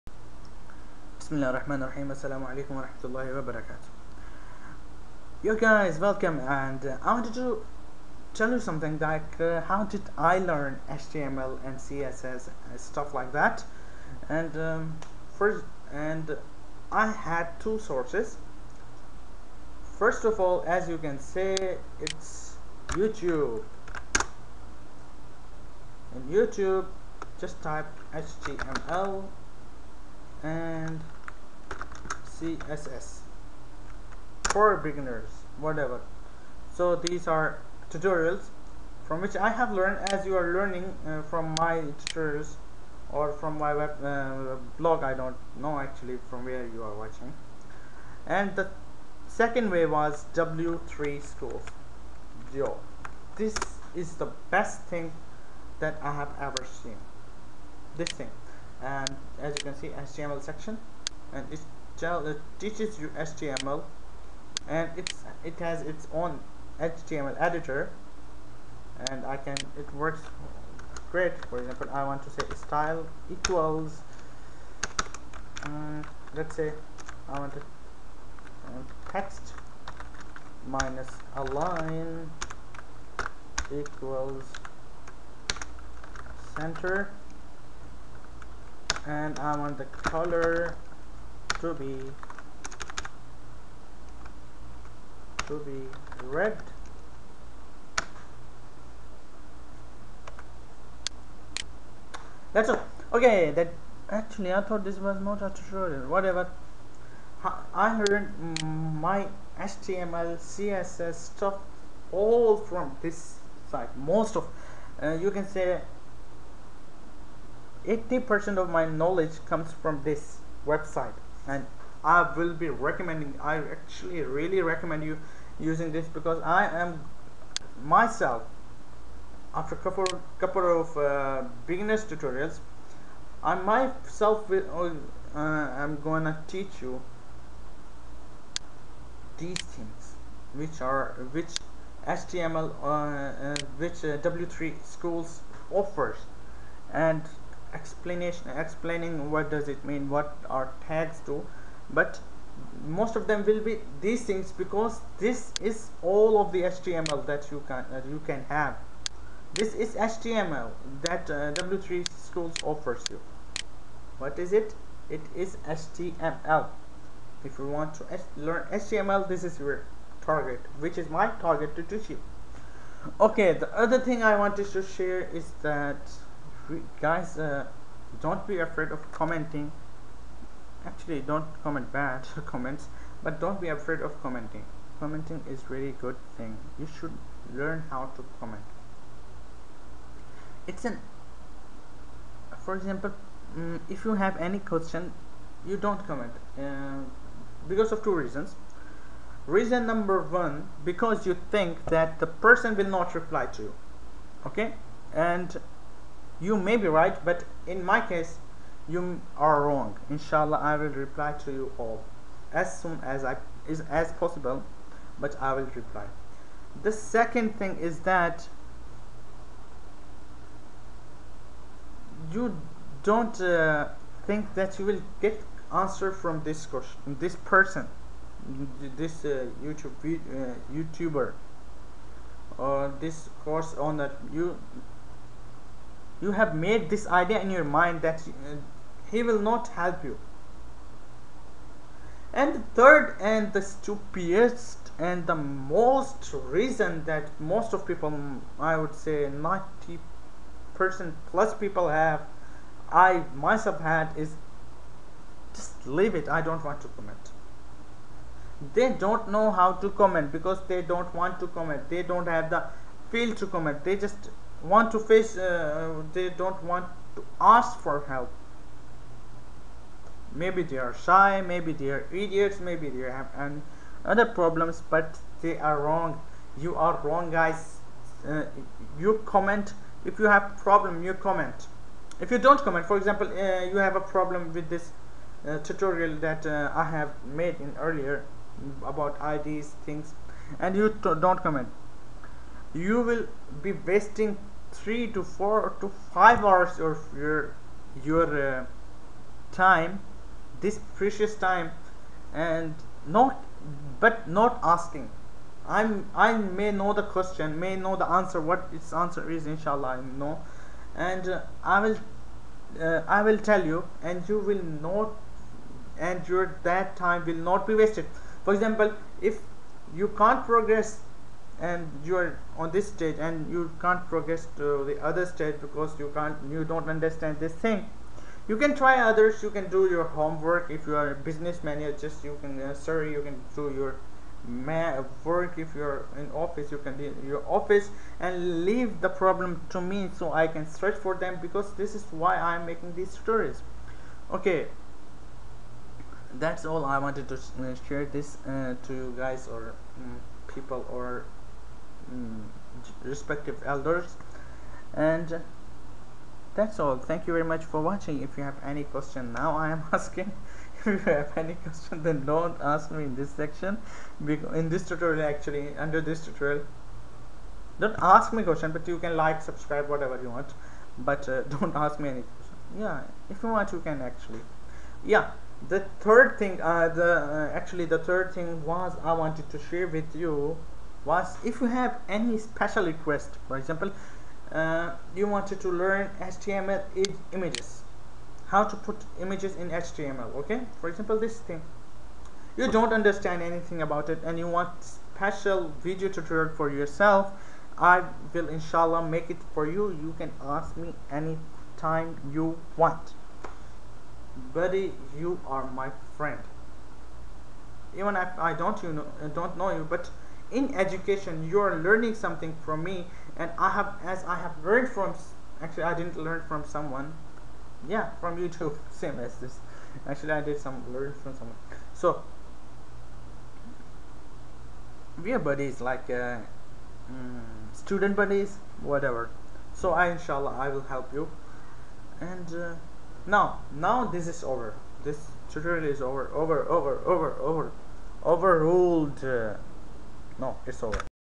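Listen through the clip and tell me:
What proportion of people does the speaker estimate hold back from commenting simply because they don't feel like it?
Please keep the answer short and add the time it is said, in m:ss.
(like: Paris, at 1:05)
90 percent plus, at 4:09.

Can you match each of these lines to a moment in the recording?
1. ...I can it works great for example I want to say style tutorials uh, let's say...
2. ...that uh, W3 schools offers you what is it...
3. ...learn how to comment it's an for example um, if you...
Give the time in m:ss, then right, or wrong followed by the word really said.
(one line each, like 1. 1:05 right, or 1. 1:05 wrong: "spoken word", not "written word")
1. 1:09 wrong: "equals", not "tutorials"
2. 2:41 right
3. 3:07 right.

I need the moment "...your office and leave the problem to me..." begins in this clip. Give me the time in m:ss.
5:37.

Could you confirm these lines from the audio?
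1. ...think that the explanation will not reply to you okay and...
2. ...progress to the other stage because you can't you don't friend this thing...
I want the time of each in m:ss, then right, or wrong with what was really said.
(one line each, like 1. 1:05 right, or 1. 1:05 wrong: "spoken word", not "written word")
1. 3:21 wrong: "person", not "explanation"
2. 5:24 wrong: "understand", not "friend".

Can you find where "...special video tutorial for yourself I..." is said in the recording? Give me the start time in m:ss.
6:34.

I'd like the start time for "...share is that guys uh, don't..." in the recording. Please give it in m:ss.
2:54.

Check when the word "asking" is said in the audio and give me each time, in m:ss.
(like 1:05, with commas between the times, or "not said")
5:04, 5:59.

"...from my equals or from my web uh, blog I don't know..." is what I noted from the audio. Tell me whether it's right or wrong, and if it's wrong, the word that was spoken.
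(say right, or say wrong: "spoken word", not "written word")
wrong: "tutorials", not "equals".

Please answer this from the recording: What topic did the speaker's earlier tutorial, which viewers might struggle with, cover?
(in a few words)
IDs.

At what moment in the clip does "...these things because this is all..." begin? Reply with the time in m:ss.
2:34.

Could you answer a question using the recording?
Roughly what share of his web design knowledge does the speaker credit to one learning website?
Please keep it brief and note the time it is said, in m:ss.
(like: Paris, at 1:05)
80%, at 1:57.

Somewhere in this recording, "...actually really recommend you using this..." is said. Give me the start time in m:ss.
2:03.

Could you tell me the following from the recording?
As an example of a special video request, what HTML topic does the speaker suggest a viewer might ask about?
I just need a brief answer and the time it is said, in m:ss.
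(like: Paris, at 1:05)
HTML images, at 6:26.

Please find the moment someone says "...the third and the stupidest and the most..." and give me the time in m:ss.
4:02.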